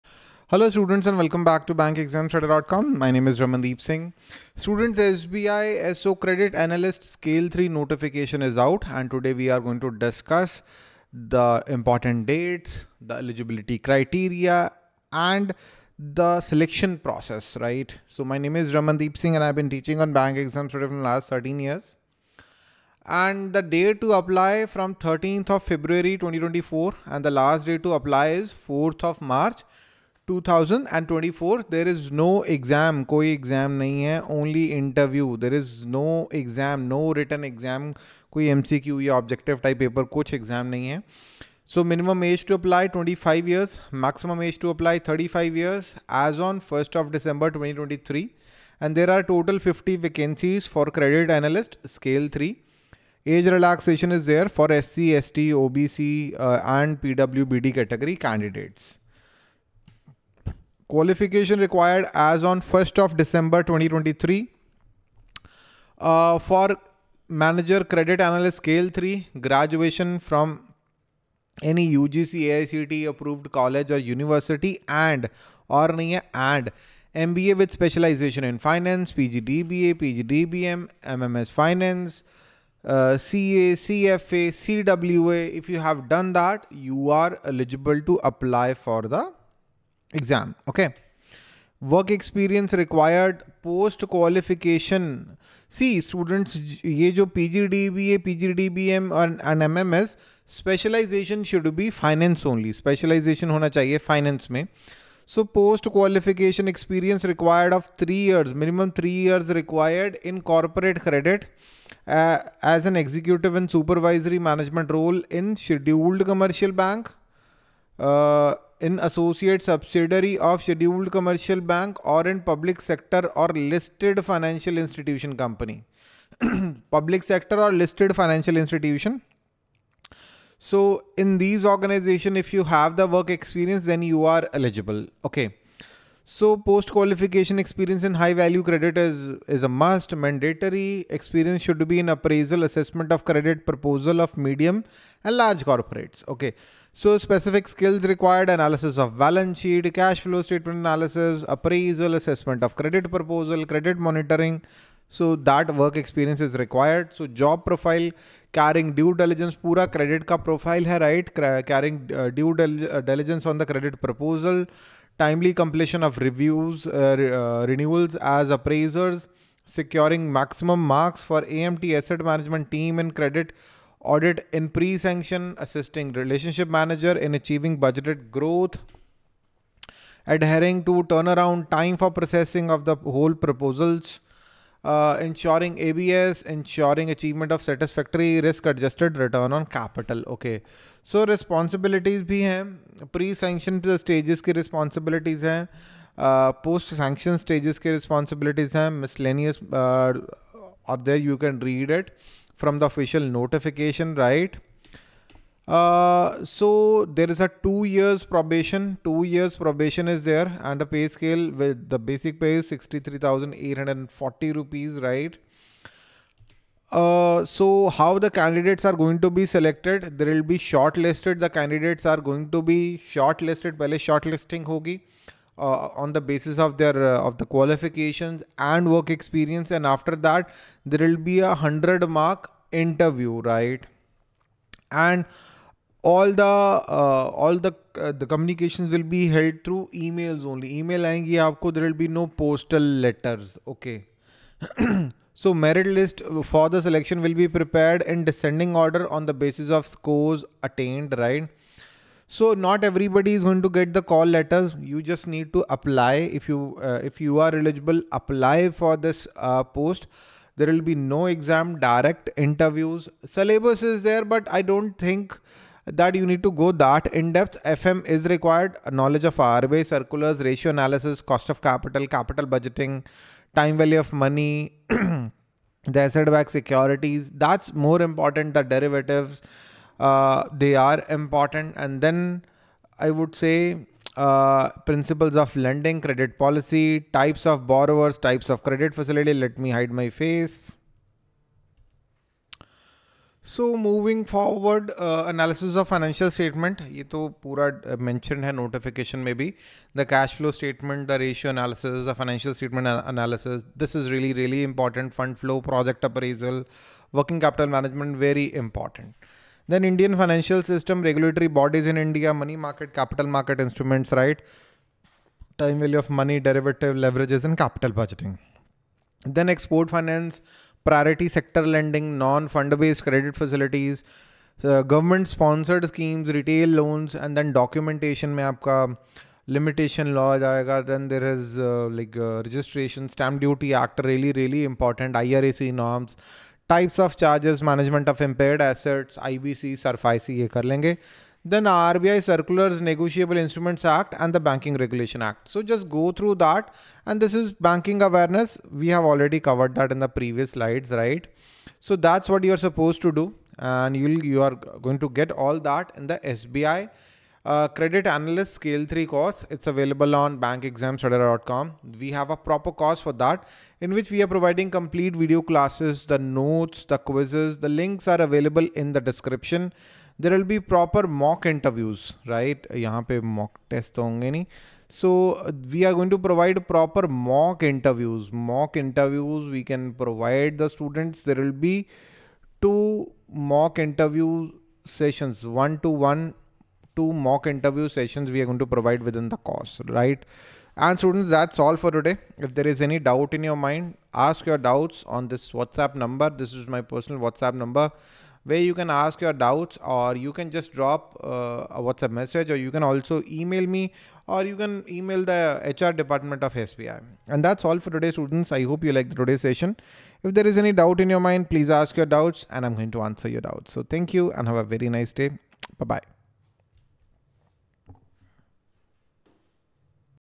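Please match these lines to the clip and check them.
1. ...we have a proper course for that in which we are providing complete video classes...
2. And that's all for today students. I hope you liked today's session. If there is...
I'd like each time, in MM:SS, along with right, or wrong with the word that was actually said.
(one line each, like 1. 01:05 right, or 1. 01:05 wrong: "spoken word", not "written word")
1. 06:01 right
2. 06:47 right.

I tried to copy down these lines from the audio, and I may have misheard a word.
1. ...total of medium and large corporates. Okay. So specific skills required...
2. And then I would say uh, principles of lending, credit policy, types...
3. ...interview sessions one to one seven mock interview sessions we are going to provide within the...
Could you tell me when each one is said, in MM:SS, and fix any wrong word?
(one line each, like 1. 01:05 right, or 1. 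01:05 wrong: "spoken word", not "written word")
1. 02:23 wrong: "proposal", not "total"
2. 04:41 right
3. 06:23 wrong: "two", not "seven".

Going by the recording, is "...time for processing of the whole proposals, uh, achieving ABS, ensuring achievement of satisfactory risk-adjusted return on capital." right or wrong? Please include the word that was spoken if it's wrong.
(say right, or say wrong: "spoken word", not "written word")
wrong: "ensuring", not "achieving".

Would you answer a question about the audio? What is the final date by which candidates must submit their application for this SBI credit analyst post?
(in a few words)
4th of March 2024.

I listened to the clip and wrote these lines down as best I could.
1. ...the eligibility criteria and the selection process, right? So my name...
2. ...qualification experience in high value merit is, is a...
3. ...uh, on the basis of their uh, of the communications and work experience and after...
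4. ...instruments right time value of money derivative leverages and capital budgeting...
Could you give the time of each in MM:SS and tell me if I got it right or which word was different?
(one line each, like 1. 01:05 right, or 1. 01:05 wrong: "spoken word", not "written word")
1. 00:12 right
2. 02:16 wrong: "credit", not "merit"
3. 03:45 wrong: "qualifications", not "communications"
4. 05:13 right.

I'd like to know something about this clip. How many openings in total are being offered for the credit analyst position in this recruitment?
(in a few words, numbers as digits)
50.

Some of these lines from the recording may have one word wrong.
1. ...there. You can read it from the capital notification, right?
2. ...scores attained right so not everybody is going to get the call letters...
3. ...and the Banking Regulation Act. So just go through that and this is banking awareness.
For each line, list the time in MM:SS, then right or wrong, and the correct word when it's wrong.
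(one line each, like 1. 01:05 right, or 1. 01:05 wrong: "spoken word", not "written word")
1. 03:21 wrong: "official", not "capital"
2. 04:09 right
3. 05:44 right.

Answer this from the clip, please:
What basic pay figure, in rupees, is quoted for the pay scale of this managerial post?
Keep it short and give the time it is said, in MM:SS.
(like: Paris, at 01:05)
63,840 rupees, at 03:32.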